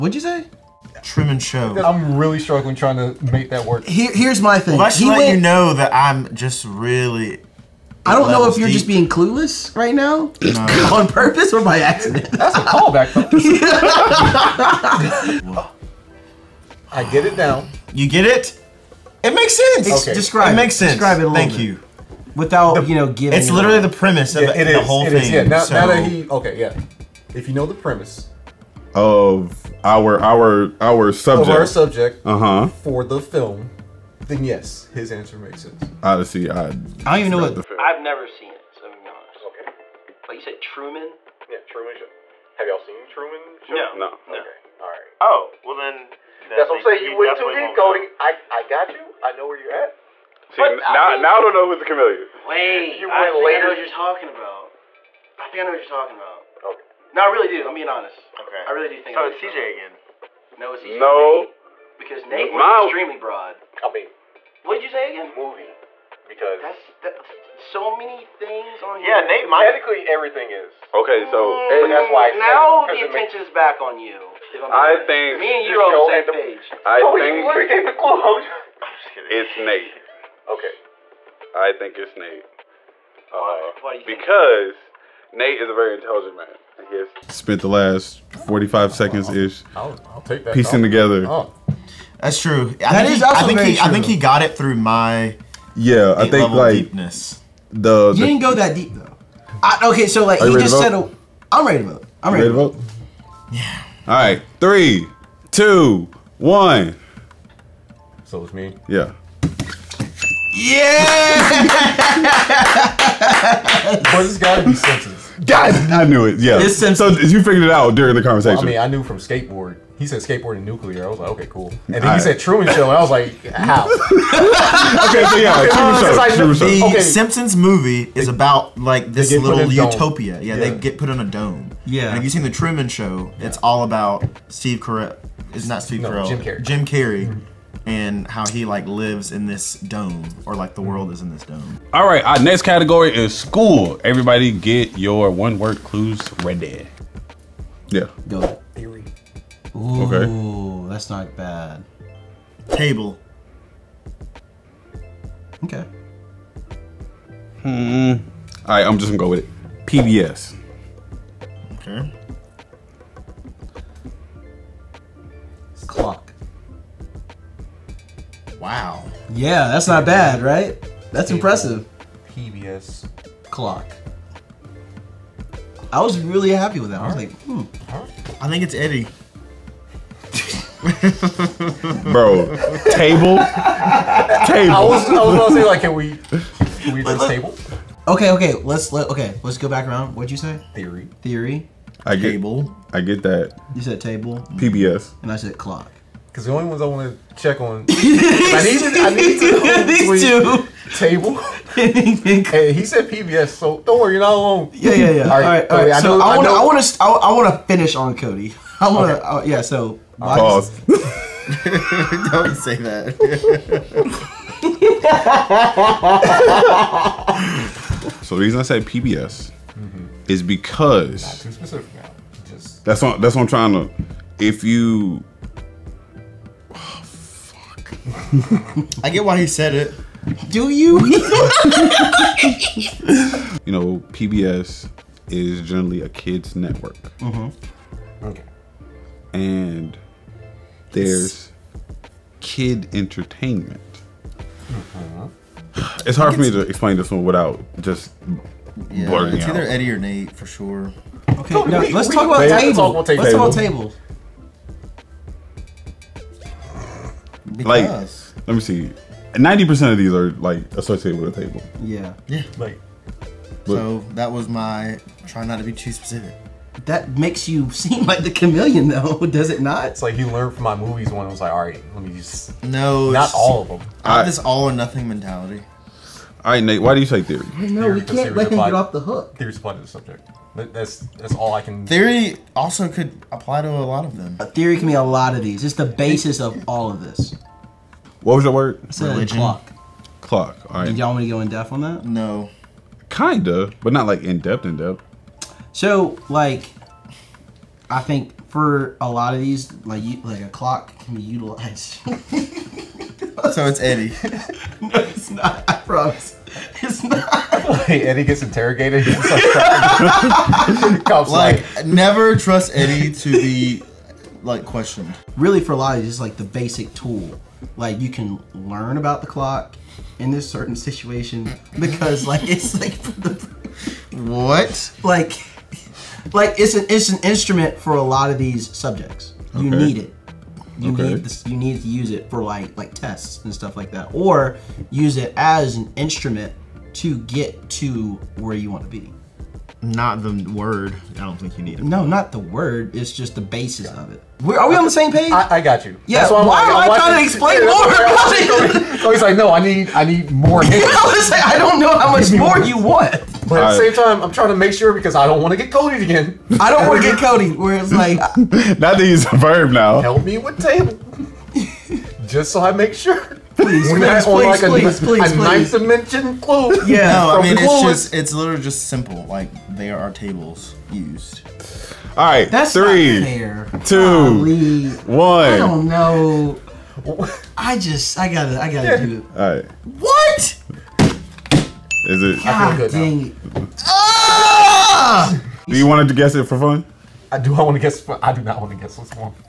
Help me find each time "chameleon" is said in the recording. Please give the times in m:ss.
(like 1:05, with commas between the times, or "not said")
0:51, 4:28.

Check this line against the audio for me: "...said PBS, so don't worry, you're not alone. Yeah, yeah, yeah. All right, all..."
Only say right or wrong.
right.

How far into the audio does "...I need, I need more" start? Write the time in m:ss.
5:49.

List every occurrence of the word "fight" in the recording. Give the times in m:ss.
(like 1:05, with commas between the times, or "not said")
not said.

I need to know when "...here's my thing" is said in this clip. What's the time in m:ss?
0:04.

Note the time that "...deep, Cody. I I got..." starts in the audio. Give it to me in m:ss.
0:47.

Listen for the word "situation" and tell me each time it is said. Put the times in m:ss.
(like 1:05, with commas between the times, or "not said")
5:20.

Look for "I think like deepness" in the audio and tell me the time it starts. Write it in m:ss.
1:36.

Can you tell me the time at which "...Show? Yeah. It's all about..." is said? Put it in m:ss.
2:12.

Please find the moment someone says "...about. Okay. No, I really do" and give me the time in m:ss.
0:56.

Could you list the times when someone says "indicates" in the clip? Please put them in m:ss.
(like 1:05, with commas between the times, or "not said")
not said.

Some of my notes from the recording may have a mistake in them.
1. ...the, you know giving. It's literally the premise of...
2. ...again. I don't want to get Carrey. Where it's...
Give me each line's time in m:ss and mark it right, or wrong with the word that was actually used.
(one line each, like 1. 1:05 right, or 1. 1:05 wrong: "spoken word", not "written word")
1. 0:22 right
2. 5:56 wrong: "Cody", not "Carrey".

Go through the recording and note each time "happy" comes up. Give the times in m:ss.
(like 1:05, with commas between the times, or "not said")
2:56.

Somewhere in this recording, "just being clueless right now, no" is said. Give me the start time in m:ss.
0:08.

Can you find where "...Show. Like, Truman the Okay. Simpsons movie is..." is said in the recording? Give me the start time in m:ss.
2:06.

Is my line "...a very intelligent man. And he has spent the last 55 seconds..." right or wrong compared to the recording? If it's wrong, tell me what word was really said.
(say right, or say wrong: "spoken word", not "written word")
wrong: "45", not "55".